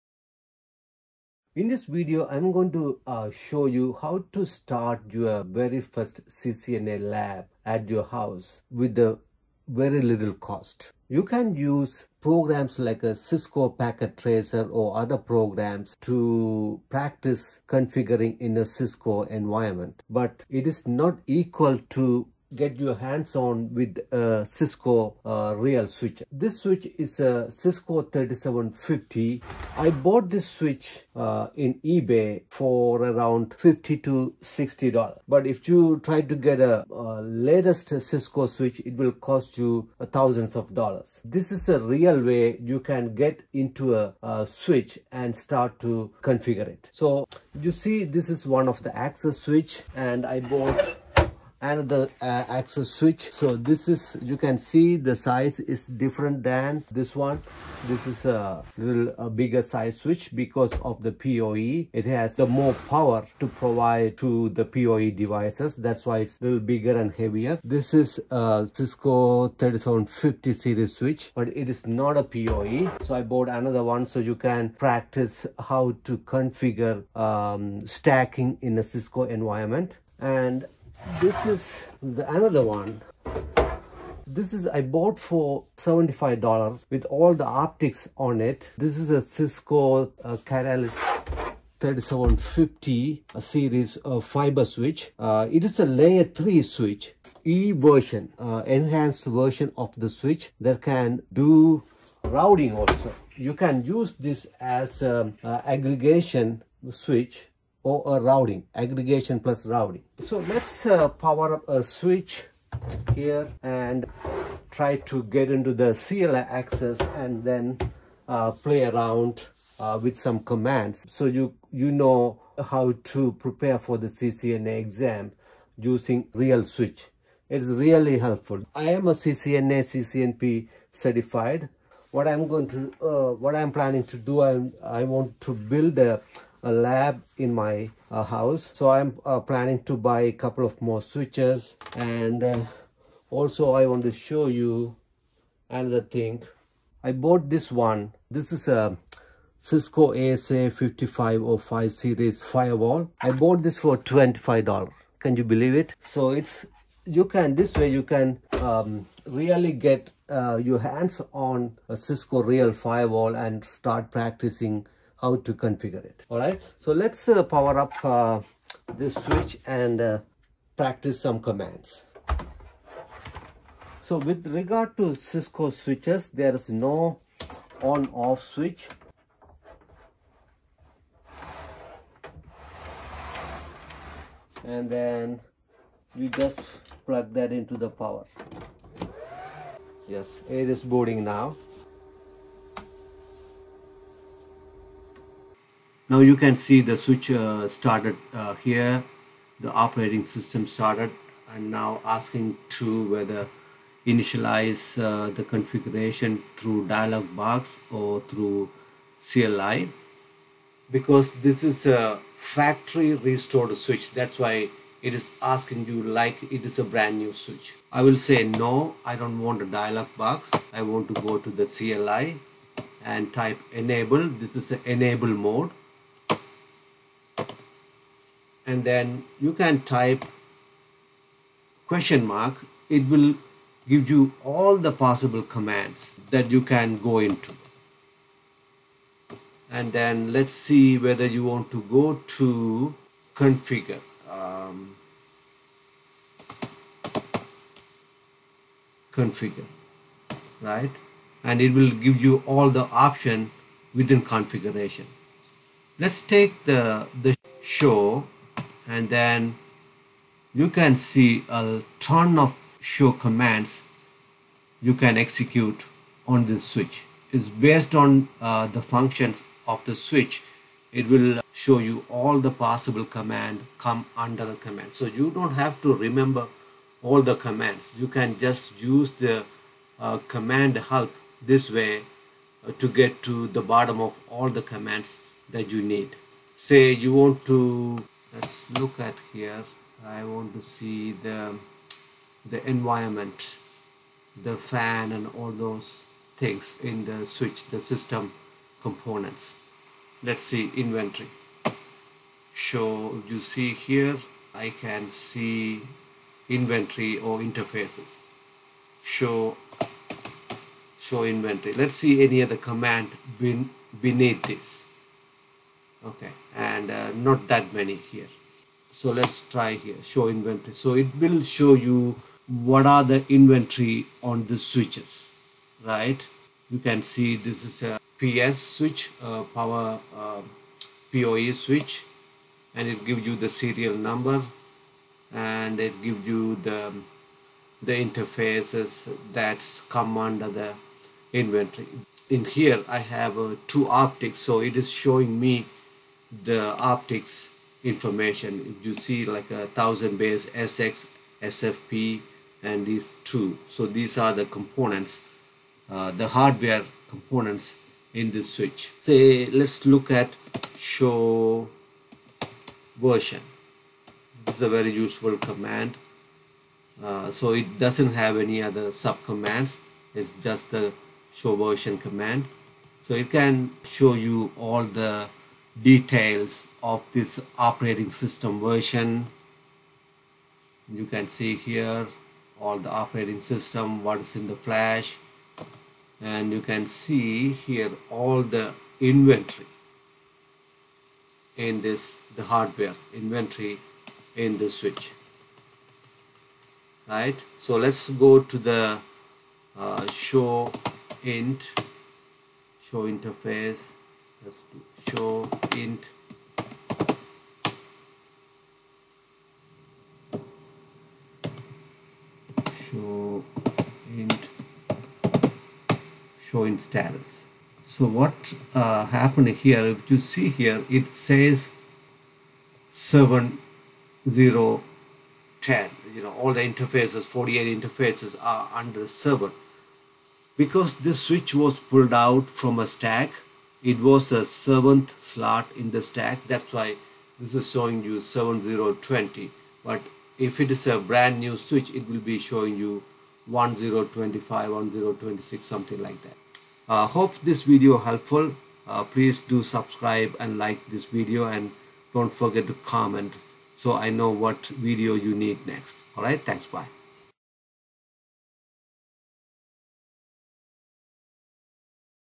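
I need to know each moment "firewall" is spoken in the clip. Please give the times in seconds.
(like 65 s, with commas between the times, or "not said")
152 s, 162 s.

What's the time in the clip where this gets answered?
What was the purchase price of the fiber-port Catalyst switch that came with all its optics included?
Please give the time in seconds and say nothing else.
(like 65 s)
85 s.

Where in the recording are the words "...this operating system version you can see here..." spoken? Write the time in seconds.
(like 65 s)
377 s.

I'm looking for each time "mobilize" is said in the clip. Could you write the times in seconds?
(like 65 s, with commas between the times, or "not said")
not said.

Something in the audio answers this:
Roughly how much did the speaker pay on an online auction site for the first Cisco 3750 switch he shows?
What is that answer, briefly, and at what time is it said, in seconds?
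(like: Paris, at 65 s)
$50 to $60, at 33 s.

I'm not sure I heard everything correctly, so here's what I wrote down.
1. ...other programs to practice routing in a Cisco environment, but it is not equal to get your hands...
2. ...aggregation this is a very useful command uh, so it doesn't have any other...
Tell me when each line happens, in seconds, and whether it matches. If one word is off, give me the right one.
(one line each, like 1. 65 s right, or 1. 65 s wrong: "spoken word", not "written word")
1. 14 s wrong: "configuring", not "routing"
2. 363 s wrong: "version", not "aggregation".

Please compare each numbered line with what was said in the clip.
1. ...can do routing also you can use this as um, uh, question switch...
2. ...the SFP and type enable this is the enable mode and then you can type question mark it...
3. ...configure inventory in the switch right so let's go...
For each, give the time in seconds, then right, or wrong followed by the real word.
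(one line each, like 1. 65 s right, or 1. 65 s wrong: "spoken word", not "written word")
1. 100 s wrong: "aggregation", not "question"
2. 221 s wrong: "CLI", not "SFP"
3. 392 s wrong: "hardware", not "configure".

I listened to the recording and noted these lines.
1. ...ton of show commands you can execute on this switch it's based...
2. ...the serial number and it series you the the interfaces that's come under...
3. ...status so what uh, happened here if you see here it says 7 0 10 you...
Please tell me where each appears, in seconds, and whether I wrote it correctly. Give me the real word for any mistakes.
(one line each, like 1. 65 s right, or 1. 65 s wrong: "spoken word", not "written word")
1. 262 s right
2. 333 s wrong: "gives", not "series"
3. 416 s right.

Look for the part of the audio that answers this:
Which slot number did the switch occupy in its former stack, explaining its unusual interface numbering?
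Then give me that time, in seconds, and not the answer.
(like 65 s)
434 s.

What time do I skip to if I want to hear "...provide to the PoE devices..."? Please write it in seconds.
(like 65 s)
63 s.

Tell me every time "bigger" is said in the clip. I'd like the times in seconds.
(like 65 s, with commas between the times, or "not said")
59 s, 66 s.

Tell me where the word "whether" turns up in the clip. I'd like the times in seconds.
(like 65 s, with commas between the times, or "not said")
203 s, 240 s.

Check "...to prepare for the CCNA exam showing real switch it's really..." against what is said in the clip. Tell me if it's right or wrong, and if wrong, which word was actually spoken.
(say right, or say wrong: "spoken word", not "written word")
wrong: "using", not "showing".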